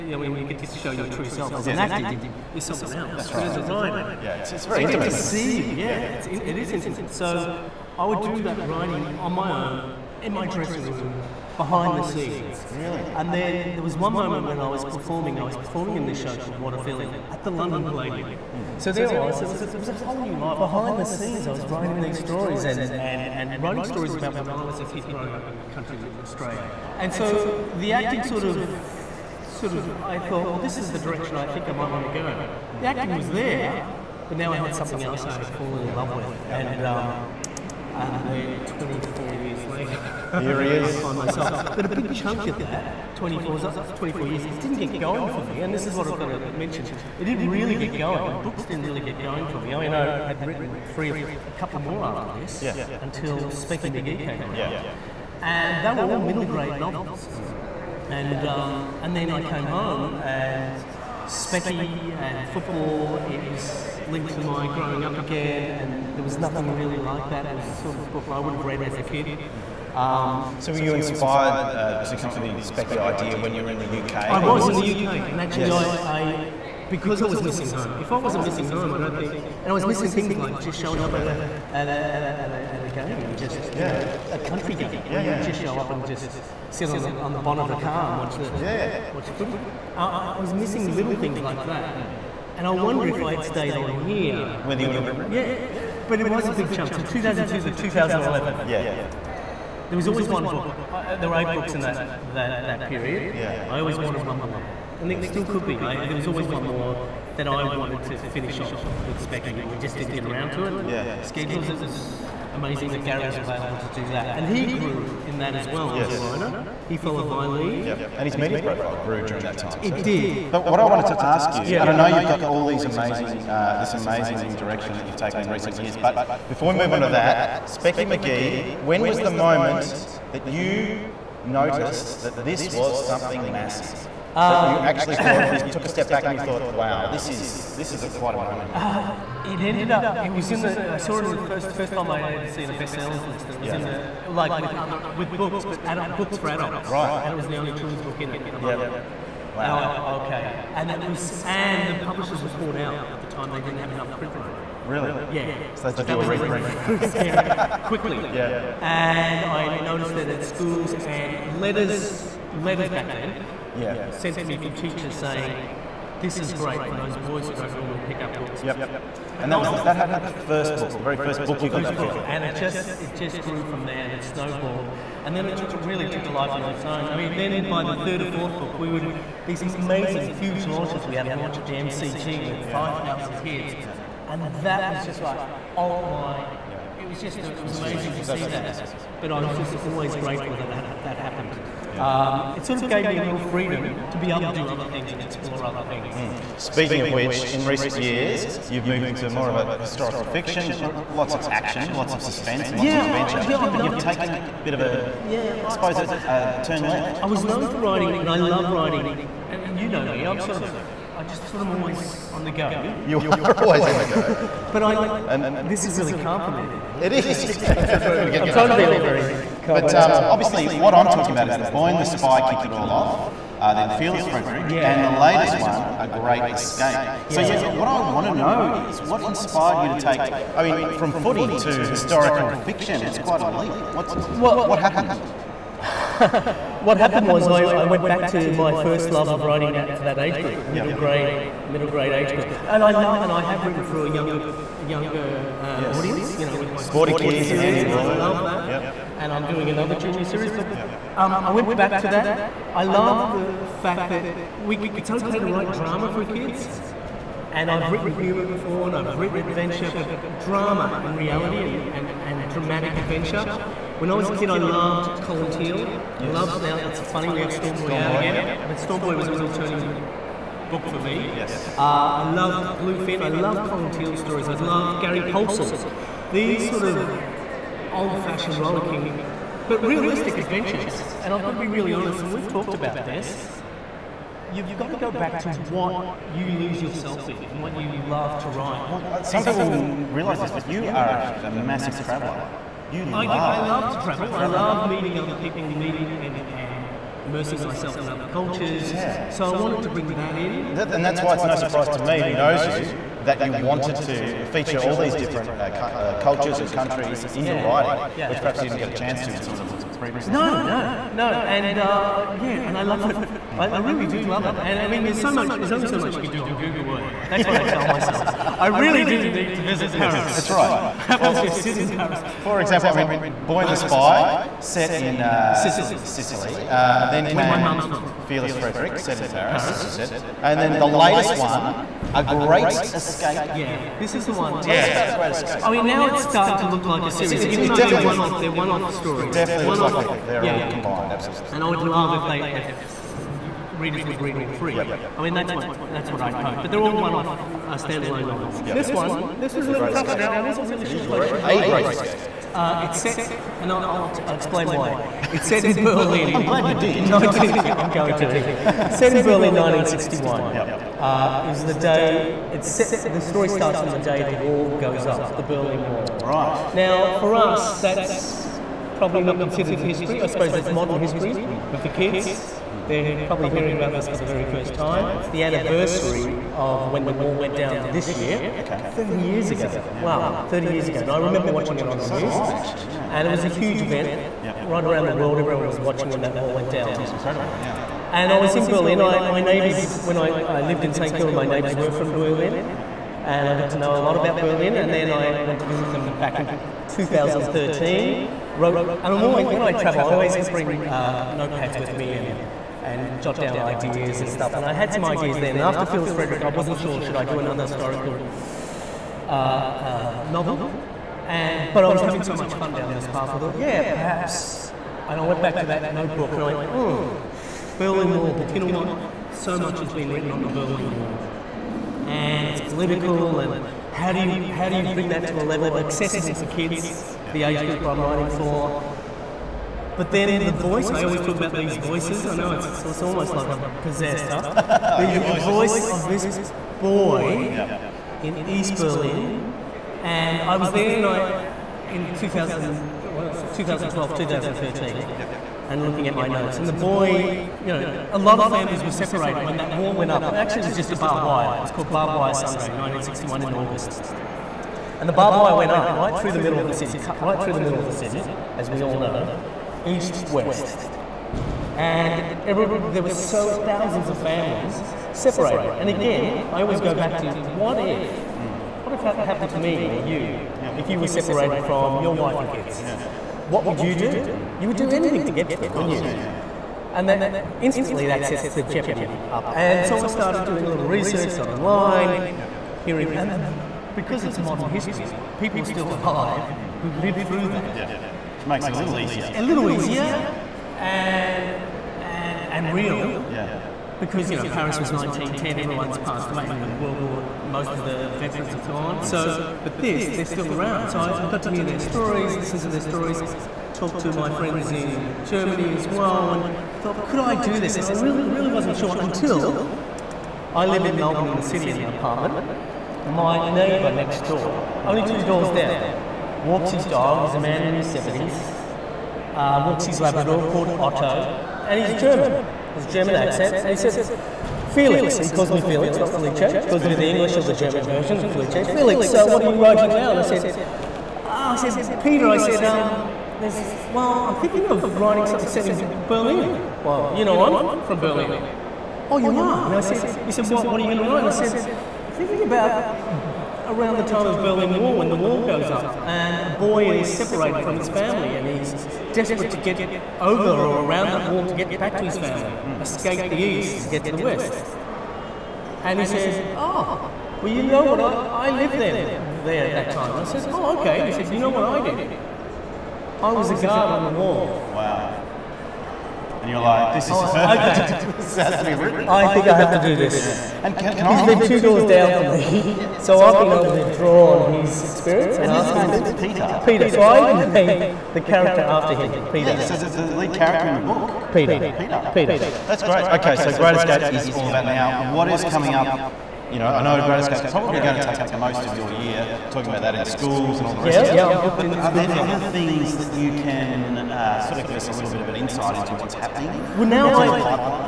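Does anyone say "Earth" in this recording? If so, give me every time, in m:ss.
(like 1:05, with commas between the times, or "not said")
5:16.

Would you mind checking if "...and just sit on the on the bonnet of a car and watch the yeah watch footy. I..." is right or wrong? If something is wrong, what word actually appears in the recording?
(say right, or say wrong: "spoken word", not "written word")
right.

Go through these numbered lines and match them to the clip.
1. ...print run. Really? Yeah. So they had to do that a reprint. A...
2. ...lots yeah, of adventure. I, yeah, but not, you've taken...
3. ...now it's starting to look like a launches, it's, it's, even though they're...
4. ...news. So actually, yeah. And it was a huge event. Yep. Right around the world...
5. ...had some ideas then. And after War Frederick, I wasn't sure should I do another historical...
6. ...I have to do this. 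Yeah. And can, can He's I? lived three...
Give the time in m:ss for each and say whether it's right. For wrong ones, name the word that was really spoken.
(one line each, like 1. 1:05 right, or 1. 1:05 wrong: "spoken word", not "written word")
1. 2:34 right
2. 3:22 right
3. 5:35 wrong: "series", not "launches"
4. 6:22 right
5. 6:44 wrong: "Fearless", not "War"
6. 9:29 wrong: "two", not "three".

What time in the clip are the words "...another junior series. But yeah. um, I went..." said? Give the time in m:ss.
4:09.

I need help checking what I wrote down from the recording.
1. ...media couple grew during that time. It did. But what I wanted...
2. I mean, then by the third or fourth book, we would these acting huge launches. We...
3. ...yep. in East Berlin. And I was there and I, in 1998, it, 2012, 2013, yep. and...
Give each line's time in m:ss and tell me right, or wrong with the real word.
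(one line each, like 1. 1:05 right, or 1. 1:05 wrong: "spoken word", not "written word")
1. 1:58 wrong: "profile", not "couple"
2. 2:57 wrong: "amazing", not "acting"
3. 7:17 wrong: "2000", not "1998".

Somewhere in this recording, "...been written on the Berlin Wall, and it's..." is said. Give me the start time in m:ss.
6:59.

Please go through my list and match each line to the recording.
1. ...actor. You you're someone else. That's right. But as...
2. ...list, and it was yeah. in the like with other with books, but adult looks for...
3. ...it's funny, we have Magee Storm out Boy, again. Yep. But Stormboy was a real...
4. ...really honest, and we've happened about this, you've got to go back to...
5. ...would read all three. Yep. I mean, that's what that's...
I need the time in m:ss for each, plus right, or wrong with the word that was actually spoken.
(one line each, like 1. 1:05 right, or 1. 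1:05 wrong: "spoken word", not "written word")
1. 0:01 right
2. 2:23 wrong: "books", not "looks"
3. 4:26 wrong: "Stormboy", not "Magee"
4. 4:41 wrong: "talked", not "happened"
5. 5:44 right.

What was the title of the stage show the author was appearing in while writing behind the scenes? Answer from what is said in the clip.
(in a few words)
What a Feeling.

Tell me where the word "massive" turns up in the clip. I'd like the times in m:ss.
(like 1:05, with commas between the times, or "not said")
2:13, 3:08, 4:51.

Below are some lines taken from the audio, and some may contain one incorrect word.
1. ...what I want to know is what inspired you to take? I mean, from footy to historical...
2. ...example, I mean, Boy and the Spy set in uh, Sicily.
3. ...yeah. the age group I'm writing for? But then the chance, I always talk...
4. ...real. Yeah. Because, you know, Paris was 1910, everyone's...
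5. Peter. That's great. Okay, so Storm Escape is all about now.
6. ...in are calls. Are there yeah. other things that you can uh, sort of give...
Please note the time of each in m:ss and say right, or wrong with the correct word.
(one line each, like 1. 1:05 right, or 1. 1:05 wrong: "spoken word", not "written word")
1. 3:47 right
2. 5:22 right
3. 7:07 wrong: "voice", not "chance"
4. 8:12 right
5. 9:42 wrong: "Great", not "Storm"
6. 9:51 wrong: "schools", not "calls".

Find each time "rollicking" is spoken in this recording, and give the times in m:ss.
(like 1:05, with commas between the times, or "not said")
4:38.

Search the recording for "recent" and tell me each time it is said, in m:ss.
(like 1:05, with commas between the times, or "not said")
2:05, 3:17.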